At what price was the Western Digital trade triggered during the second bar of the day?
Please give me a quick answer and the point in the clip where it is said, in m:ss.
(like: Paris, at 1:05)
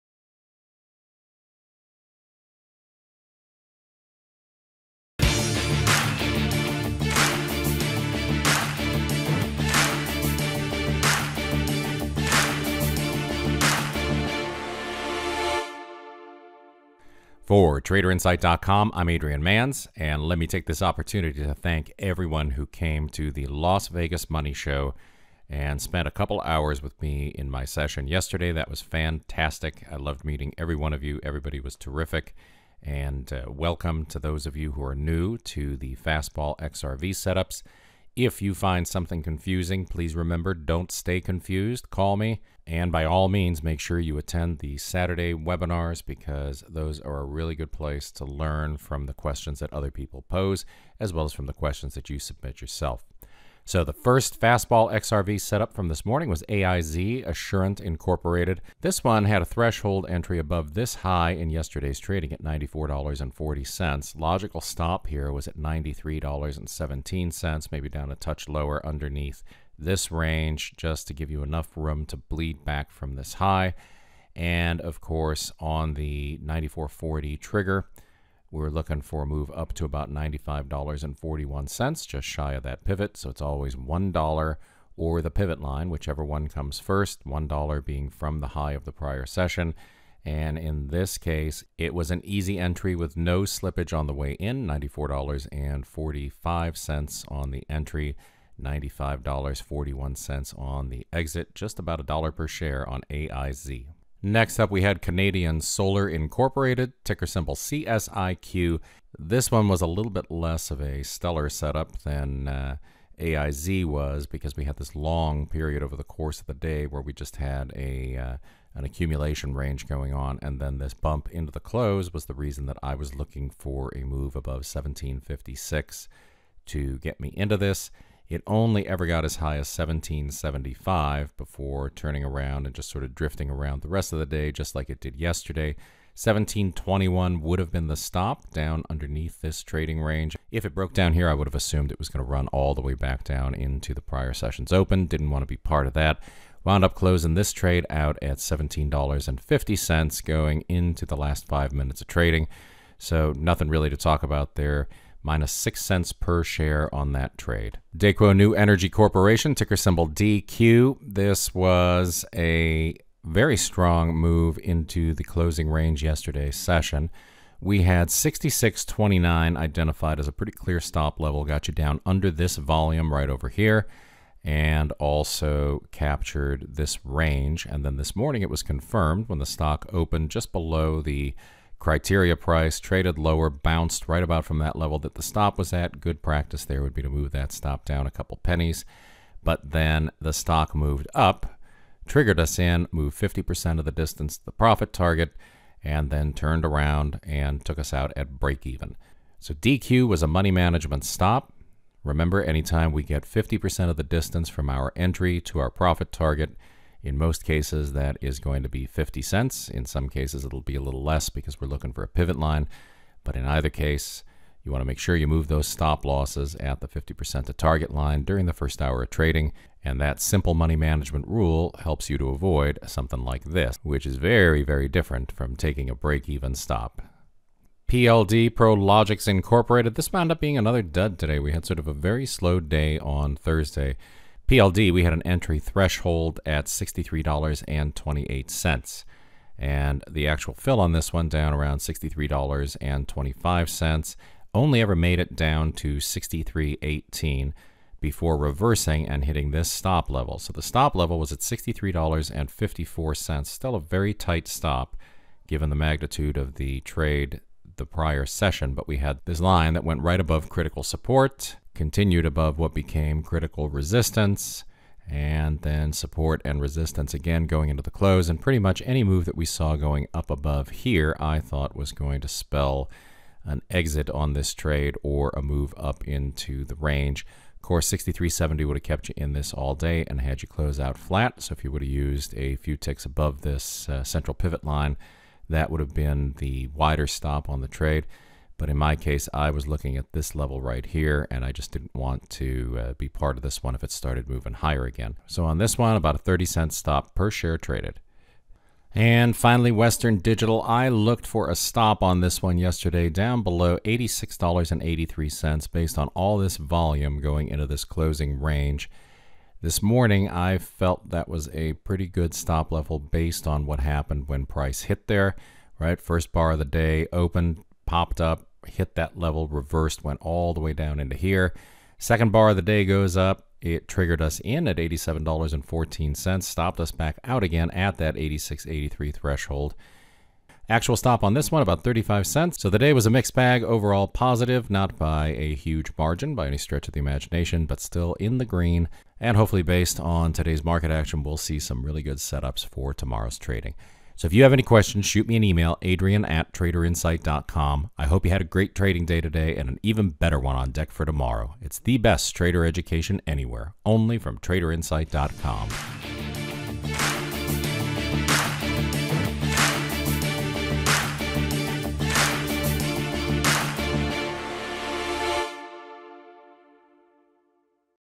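$87.14, at 5:24.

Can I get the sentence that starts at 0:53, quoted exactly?
So, the first fastball XRV setup from this morning was AIZ Assurant Incorporated.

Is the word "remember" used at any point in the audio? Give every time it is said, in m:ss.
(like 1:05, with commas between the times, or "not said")
0:40, 3:22.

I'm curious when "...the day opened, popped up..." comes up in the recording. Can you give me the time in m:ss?
5:16.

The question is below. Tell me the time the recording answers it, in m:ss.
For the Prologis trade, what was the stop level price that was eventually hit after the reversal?
4:11.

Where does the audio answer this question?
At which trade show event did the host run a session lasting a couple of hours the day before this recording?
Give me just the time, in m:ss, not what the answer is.
0:23.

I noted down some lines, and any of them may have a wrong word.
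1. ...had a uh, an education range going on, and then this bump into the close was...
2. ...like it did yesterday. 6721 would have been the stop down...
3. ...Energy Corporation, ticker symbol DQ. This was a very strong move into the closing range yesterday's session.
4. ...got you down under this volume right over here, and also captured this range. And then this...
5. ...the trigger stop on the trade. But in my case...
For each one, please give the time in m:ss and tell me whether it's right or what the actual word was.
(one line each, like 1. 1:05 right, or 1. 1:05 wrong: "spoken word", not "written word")
1. 1:57 wrong: "accumulation", not "education"
2. 2:14 wrong: "1721", not "6721"
3. 2:38 right
4. 2:51 right
5. 4:46 wrong: "wider", not "trigger".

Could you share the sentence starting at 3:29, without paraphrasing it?
In some cases, it'll be a little less because we're looking for a pivot line.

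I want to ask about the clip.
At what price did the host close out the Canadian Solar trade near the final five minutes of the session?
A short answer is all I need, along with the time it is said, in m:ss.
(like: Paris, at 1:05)
$17.50, at 2:28.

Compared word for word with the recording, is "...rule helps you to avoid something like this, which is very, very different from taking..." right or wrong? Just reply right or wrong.
right.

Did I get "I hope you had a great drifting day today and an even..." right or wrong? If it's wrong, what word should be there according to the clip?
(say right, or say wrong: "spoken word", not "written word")
wrong: "trading", not "drifting".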